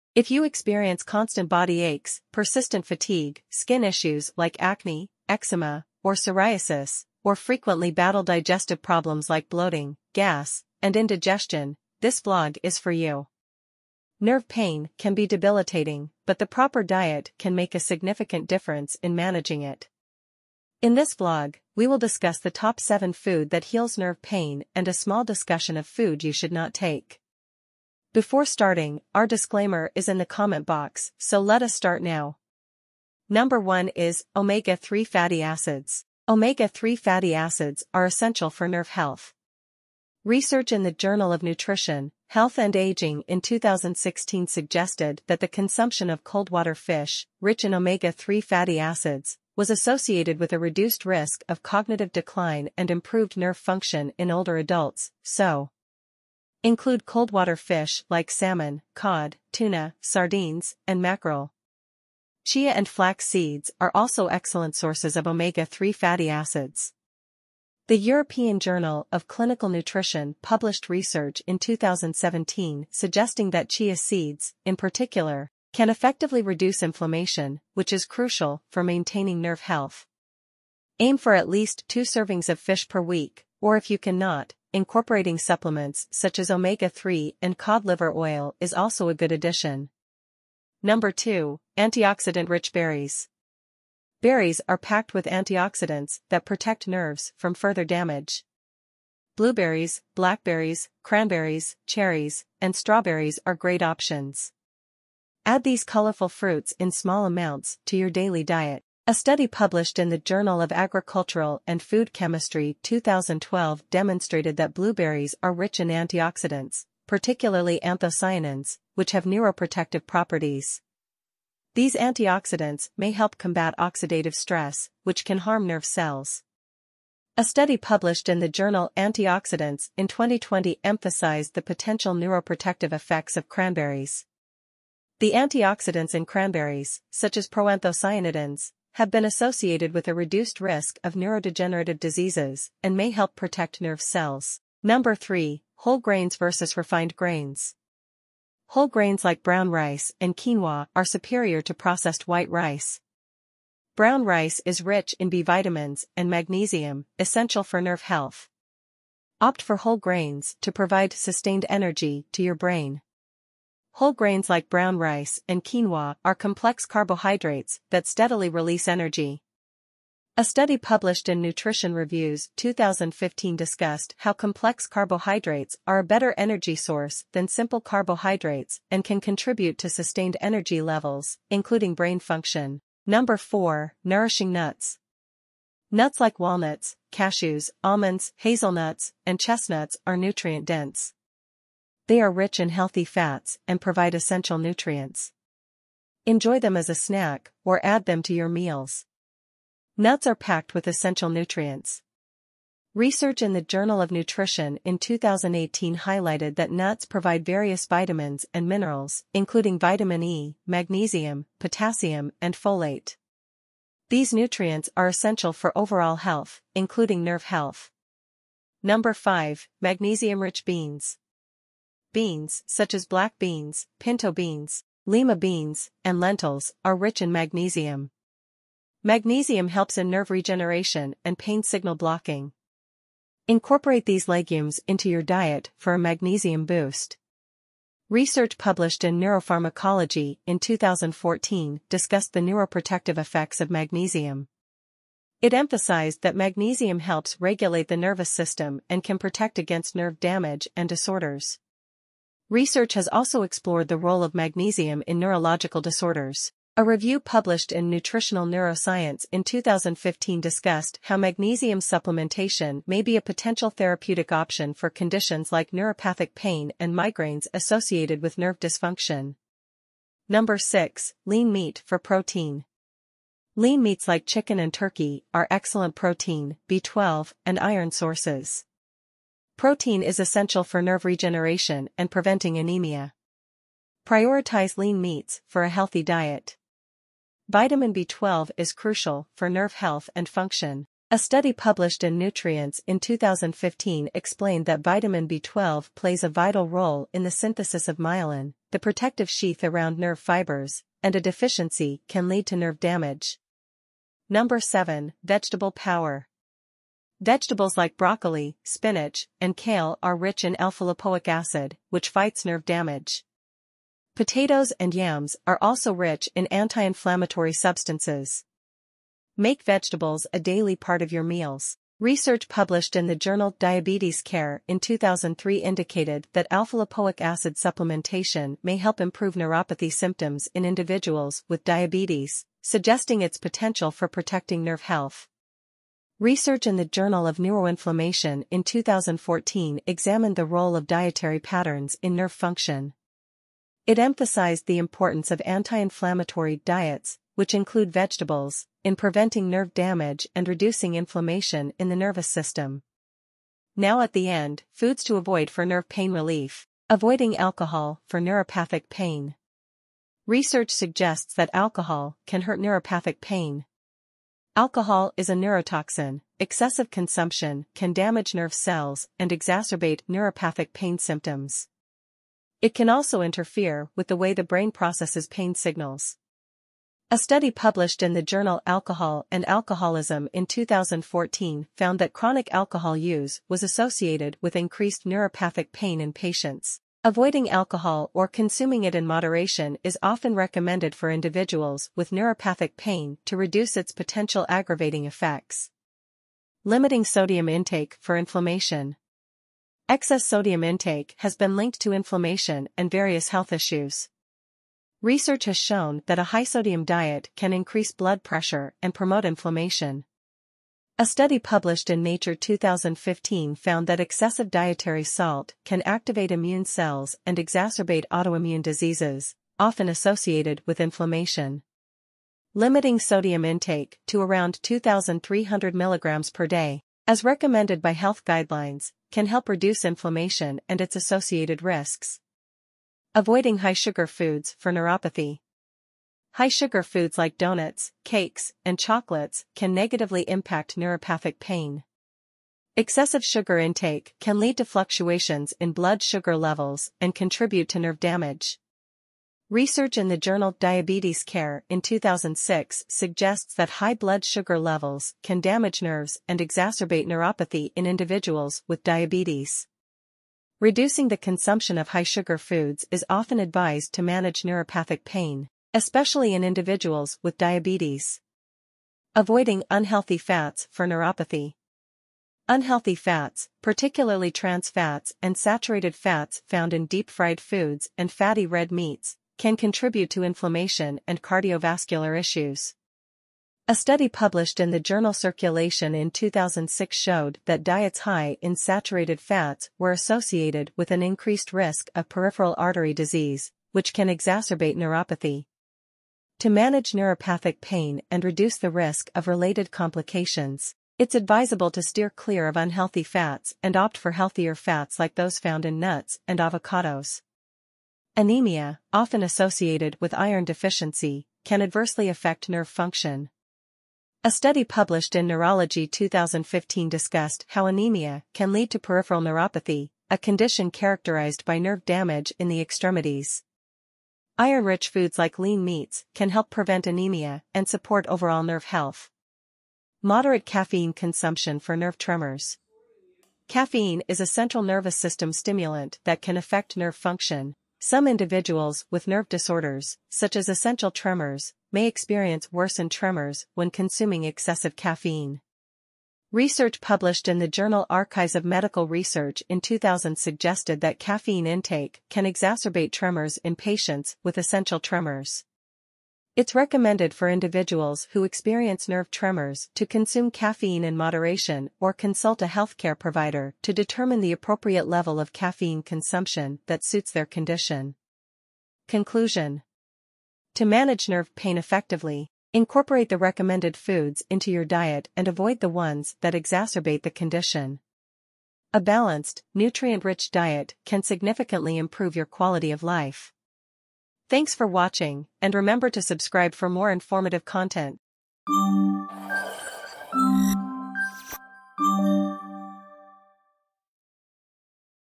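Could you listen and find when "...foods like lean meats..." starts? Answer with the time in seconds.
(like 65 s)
524 s.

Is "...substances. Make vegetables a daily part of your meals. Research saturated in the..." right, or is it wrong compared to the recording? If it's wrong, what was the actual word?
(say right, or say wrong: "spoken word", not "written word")
wrong: "published", not "saturated".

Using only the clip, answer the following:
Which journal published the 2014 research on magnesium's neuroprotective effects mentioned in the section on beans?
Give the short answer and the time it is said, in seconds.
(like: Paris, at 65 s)
Neuropharmacology, at 239 s.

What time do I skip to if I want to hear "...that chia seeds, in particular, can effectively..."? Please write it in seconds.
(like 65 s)
73 s.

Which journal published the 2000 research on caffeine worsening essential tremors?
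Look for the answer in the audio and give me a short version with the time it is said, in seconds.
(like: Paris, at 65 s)
Archives of Medical Research, at 547 s.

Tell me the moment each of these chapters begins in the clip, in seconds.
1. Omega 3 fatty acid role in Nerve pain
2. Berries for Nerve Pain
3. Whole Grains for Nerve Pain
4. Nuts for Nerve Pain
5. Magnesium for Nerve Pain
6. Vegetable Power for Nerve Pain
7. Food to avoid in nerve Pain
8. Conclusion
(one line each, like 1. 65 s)
1. 44 s
2. 103 s
3. 149 s
4. 185 s
5. 230 s
6. 310 s
7. 345 s
8. 569 s.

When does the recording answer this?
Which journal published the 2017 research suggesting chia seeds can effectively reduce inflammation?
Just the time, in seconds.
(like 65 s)
67 s.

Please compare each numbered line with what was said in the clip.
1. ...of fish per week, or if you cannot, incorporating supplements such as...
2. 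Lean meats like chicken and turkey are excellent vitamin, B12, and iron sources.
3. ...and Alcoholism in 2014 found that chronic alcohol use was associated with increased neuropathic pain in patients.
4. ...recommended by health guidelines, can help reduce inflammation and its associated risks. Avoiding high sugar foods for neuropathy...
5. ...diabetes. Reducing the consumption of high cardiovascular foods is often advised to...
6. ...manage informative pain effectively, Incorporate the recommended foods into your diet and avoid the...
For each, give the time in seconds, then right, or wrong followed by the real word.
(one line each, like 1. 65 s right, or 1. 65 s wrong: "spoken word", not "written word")
1. 82 s right
2. 273 s wrong: "protein", not "vitamin"
3. 379 s right
4. 427 s right
5. 458 s wrong: "sugar", not "cardiovascular"
6. 570 s wrong: "nerve", not "informative".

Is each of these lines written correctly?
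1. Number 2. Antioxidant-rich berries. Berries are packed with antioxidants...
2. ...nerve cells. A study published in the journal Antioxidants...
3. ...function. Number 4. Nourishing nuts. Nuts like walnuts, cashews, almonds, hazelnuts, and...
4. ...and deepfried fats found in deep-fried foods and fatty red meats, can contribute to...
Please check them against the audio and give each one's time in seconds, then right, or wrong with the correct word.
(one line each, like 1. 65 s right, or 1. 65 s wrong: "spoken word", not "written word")
1. 90 s right
2. 125 s right
3. 182 s right
4. 475 s wrong: "saturated", not "deepfried".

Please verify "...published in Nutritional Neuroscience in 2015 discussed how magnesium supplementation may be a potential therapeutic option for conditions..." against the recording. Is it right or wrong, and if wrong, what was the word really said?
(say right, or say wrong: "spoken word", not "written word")
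right.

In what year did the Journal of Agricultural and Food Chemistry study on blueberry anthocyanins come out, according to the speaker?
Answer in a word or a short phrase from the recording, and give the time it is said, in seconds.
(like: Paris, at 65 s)
2012, at 112 s.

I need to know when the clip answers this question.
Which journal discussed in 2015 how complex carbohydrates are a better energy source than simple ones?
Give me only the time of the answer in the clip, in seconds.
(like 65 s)
171 s.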